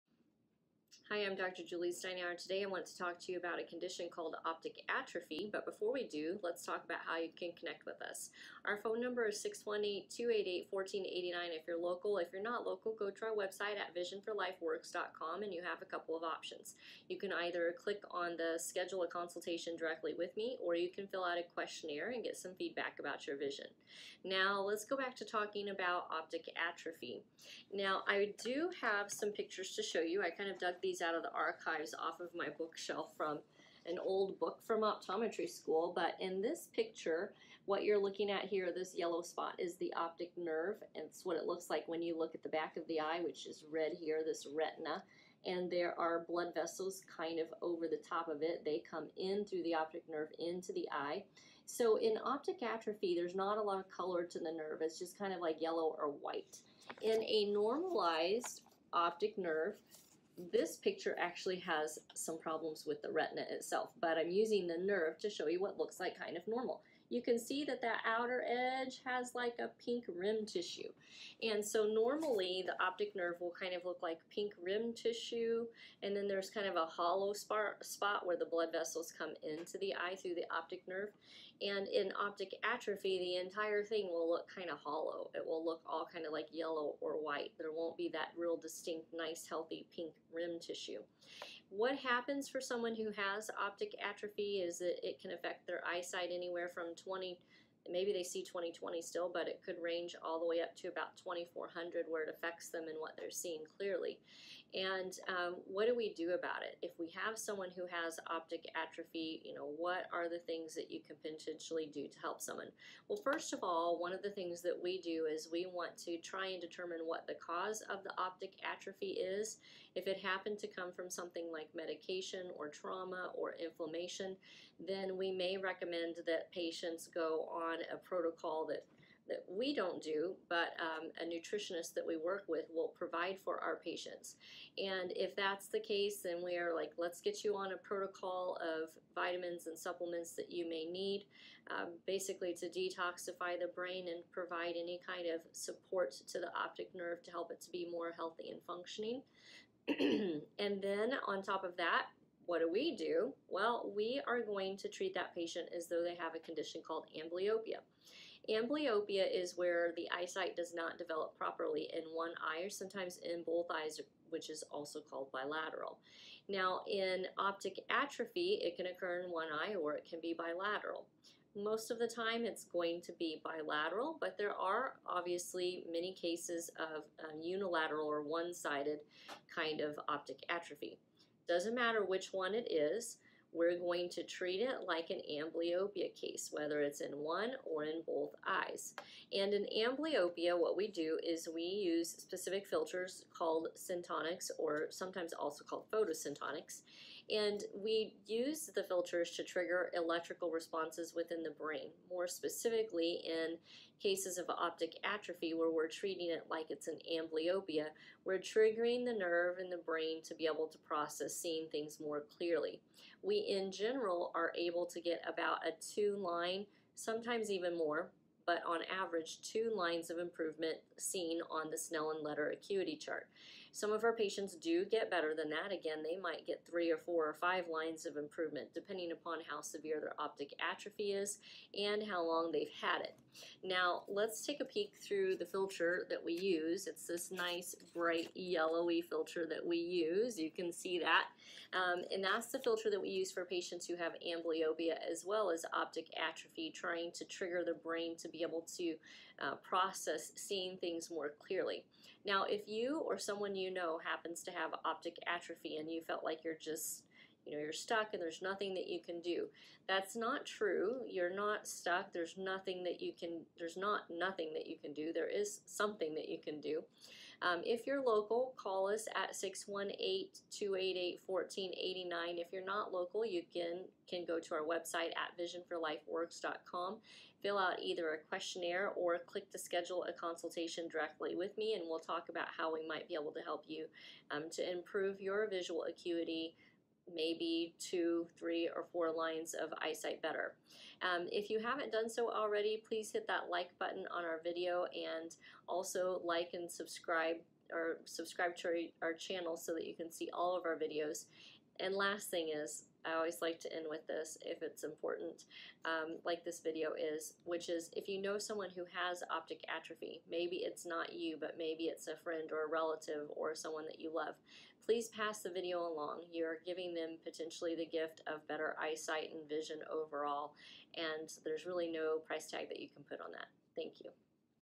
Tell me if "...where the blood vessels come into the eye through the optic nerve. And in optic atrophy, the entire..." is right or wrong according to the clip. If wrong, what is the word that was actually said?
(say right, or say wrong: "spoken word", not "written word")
right.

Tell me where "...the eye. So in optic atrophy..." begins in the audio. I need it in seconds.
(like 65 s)
50 s.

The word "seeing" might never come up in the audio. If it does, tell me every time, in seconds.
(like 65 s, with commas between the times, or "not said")
103 s, 211 s, 250 s.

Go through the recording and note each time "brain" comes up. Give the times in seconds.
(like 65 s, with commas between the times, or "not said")
143 s, 201 s, 209 s, 247 s.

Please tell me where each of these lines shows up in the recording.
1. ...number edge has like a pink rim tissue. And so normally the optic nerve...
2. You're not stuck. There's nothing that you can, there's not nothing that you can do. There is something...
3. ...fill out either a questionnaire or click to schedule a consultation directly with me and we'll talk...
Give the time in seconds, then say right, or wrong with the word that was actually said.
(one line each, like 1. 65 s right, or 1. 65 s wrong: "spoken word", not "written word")
1. 68 s wrong: "outer", not "number"
2. 261 s right
3. 277 s right.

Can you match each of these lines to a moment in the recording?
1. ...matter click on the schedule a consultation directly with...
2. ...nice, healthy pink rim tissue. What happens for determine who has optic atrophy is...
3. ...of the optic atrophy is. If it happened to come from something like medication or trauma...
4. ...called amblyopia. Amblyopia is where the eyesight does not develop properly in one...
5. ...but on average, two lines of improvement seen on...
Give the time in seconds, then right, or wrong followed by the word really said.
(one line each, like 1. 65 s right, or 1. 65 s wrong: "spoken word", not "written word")
1. 17 s wrong: "either", not "matter"
2. 89 s wrong: "someone", not "determine"
3. 117 s right
4. 156 s right
5. 218 s right.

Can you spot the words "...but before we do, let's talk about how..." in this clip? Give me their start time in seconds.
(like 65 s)
5 s.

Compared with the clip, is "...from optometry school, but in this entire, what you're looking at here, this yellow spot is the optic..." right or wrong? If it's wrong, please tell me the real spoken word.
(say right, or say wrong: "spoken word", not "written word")
wrong: "picture", not "entire".